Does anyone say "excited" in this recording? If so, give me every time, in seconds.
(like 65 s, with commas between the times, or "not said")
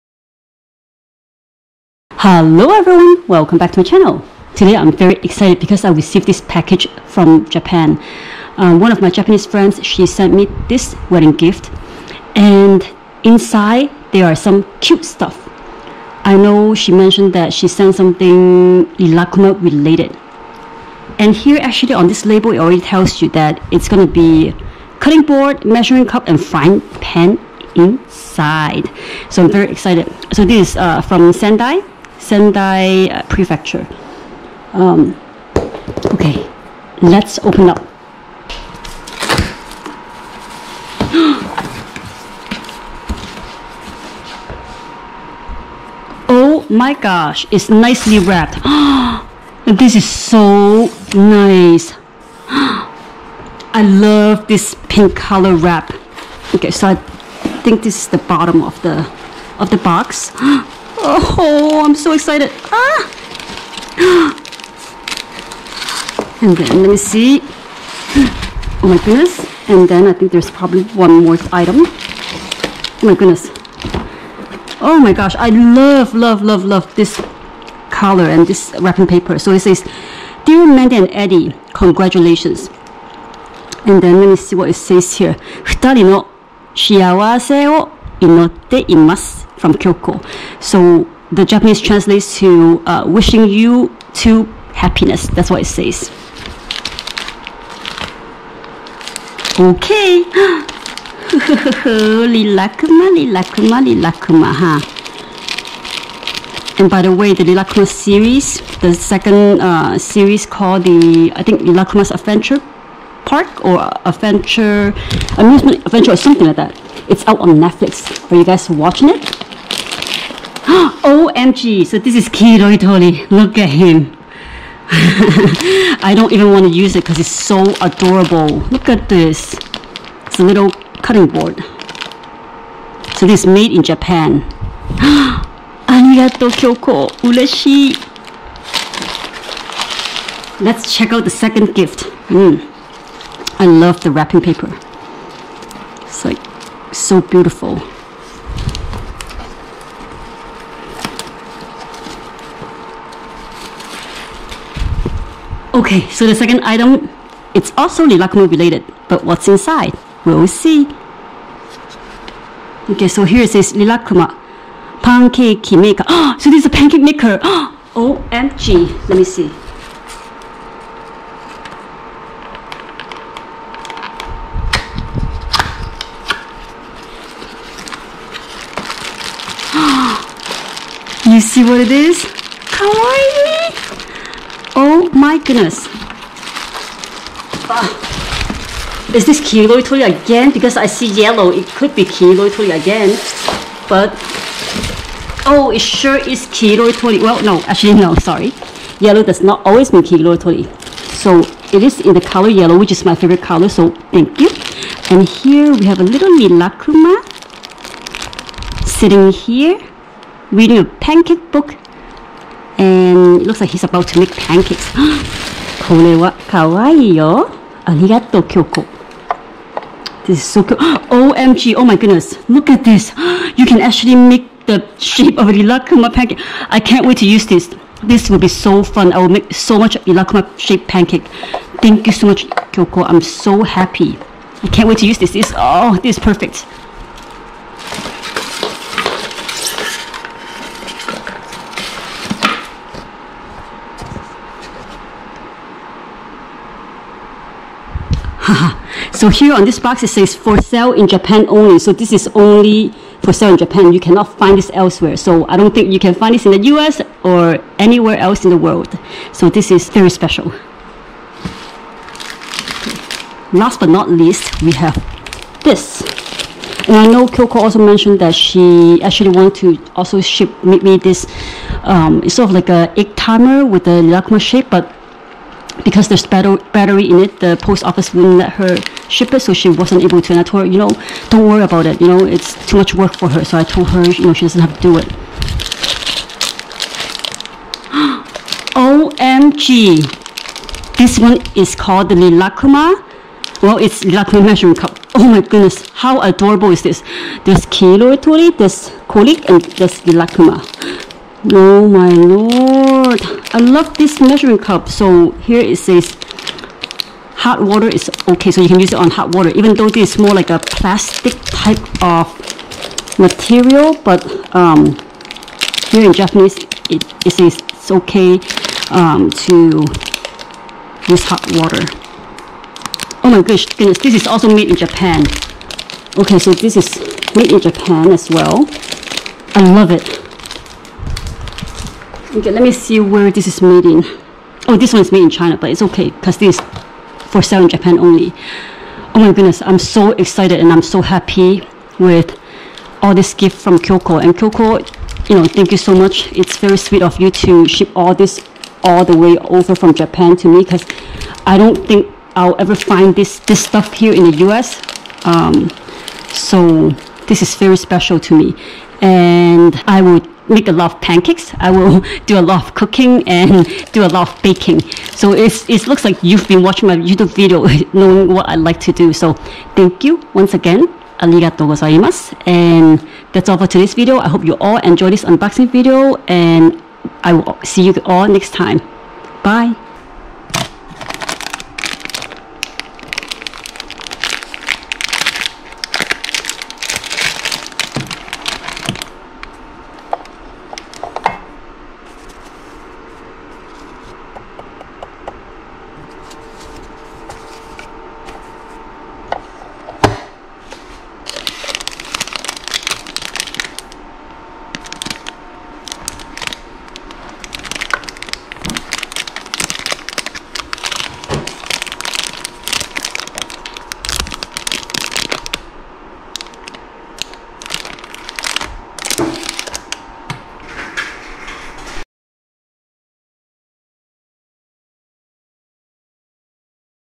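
5 s, 29 s, 62 s, 340 s.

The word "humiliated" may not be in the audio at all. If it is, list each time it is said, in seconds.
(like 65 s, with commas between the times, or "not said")
not said.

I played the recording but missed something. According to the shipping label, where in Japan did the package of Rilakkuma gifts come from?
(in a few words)
Sendai.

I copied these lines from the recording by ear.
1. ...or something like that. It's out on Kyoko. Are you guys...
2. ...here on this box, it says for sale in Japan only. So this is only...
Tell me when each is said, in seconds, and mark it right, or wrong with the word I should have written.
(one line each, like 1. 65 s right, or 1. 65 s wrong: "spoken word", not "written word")
1. 116 s wrong: "Netflix", not "Kyoko"
2. 249 s right.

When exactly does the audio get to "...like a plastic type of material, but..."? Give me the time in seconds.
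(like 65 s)
310 s.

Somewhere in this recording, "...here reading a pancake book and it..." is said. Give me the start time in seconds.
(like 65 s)
209 s.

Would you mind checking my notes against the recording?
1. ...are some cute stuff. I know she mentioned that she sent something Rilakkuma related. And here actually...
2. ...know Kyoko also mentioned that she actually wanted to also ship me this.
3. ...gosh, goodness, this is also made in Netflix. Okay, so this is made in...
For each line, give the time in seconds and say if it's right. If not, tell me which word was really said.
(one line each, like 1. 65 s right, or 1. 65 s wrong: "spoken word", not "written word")
1. 14 s right
2. 267 s right
3. 323 s wrong: "Japan", not "Netflix".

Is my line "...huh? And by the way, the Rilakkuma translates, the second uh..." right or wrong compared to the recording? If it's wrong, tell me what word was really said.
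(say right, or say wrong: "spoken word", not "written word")
wrong: "series", not "translates".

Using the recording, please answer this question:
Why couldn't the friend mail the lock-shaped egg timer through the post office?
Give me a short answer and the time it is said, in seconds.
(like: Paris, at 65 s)
battery in it, at 276 s.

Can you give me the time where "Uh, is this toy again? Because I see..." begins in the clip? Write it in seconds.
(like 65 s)
187 s.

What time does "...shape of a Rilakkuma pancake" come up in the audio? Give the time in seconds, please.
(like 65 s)
224 s.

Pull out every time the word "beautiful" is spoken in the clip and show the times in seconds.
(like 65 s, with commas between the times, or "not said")
147 s.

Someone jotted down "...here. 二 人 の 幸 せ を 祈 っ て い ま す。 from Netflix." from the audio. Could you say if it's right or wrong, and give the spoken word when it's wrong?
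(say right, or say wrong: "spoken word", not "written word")
wrong: "Kyoko", not "Netflix".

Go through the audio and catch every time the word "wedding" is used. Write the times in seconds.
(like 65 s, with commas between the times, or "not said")
11 s.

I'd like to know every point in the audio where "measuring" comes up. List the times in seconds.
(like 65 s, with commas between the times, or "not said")
25 s, 294 s, 304 s.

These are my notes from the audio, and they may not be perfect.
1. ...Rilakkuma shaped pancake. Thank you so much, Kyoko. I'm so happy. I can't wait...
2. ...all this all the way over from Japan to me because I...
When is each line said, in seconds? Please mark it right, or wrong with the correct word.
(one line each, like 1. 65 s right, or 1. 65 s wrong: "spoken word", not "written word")
1. 230 s right
2. 347 s right.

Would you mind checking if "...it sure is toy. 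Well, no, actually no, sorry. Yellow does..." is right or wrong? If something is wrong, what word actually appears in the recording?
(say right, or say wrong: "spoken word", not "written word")
right.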